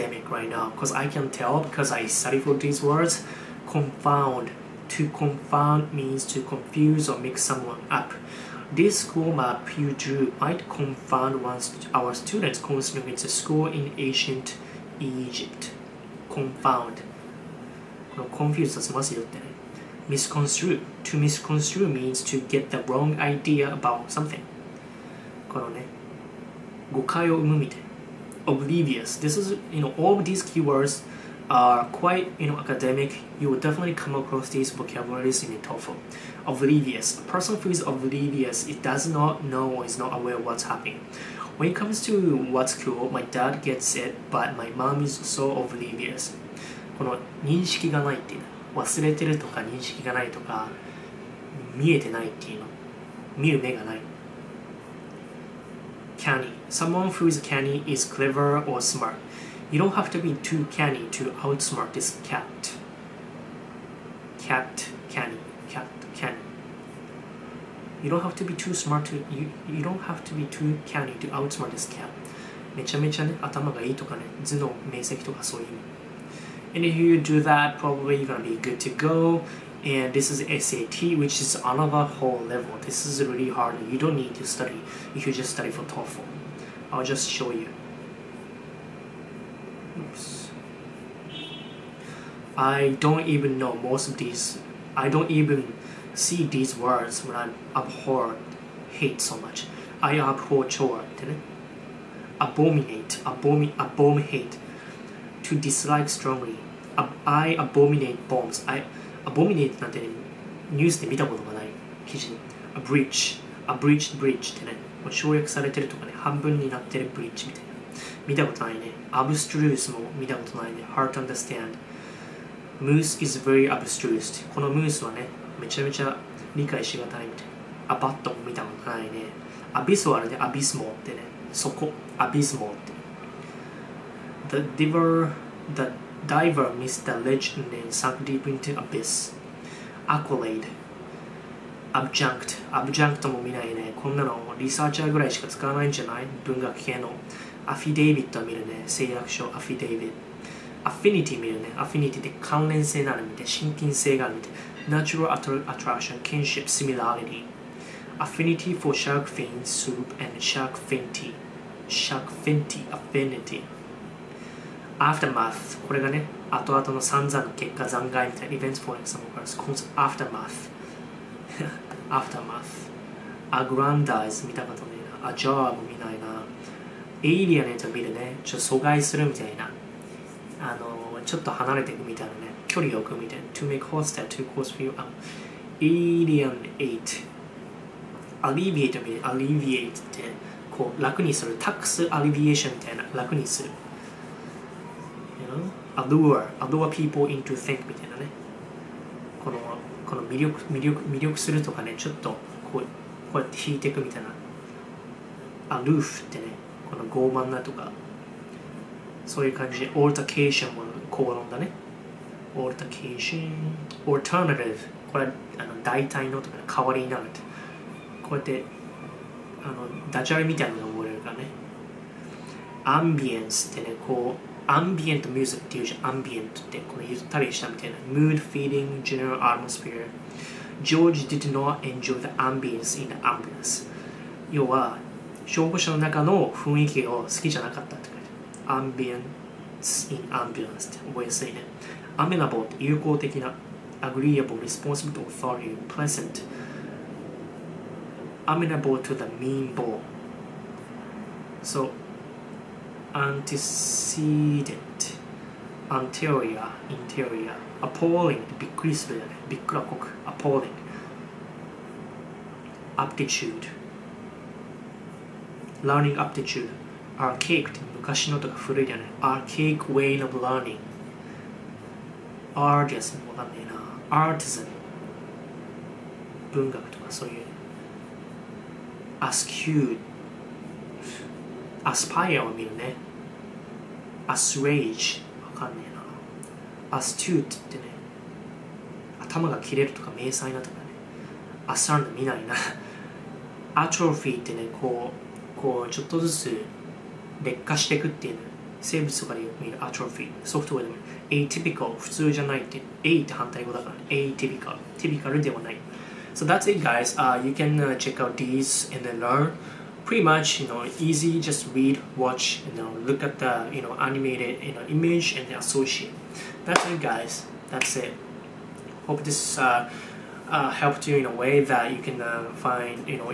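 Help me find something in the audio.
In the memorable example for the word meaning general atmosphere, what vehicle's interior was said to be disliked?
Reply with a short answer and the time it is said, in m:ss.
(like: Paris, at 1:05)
ambulance, at 3:53.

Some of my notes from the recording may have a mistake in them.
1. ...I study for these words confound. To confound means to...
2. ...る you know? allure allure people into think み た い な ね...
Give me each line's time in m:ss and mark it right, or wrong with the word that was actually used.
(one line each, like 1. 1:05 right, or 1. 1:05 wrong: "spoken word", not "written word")
1. 0:01 right
2. 3:13 right.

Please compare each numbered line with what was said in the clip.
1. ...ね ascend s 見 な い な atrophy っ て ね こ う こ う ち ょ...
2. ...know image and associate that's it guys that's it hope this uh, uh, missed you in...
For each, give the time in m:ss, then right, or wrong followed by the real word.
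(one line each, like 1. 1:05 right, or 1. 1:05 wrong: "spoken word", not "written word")
1. 4:50 right
2. 5:14 wrong: "helped", not "missed".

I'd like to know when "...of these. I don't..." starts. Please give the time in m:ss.
1:34.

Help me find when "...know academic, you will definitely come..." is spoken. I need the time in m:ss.
0:32.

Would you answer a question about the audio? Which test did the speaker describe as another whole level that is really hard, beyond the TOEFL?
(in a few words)
SAT.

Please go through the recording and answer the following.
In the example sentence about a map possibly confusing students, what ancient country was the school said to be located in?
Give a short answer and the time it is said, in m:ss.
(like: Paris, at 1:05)
Egypt, at 0:13.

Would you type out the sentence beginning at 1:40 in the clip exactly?
I abhor chore, didn't Abominate, abomi, abominate, to dislike strongly.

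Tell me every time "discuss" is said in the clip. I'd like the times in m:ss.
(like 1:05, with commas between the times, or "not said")
not said.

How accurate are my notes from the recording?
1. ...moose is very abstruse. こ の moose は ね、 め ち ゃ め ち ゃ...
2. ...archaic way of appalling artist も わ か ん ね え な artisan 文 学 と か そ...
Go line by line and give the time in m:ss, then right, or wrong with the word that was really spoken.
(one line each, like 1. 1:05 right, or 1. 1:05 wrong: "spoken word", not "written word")
1. 2:02 right
2. 4:29 wrong: "learning", not "appalling".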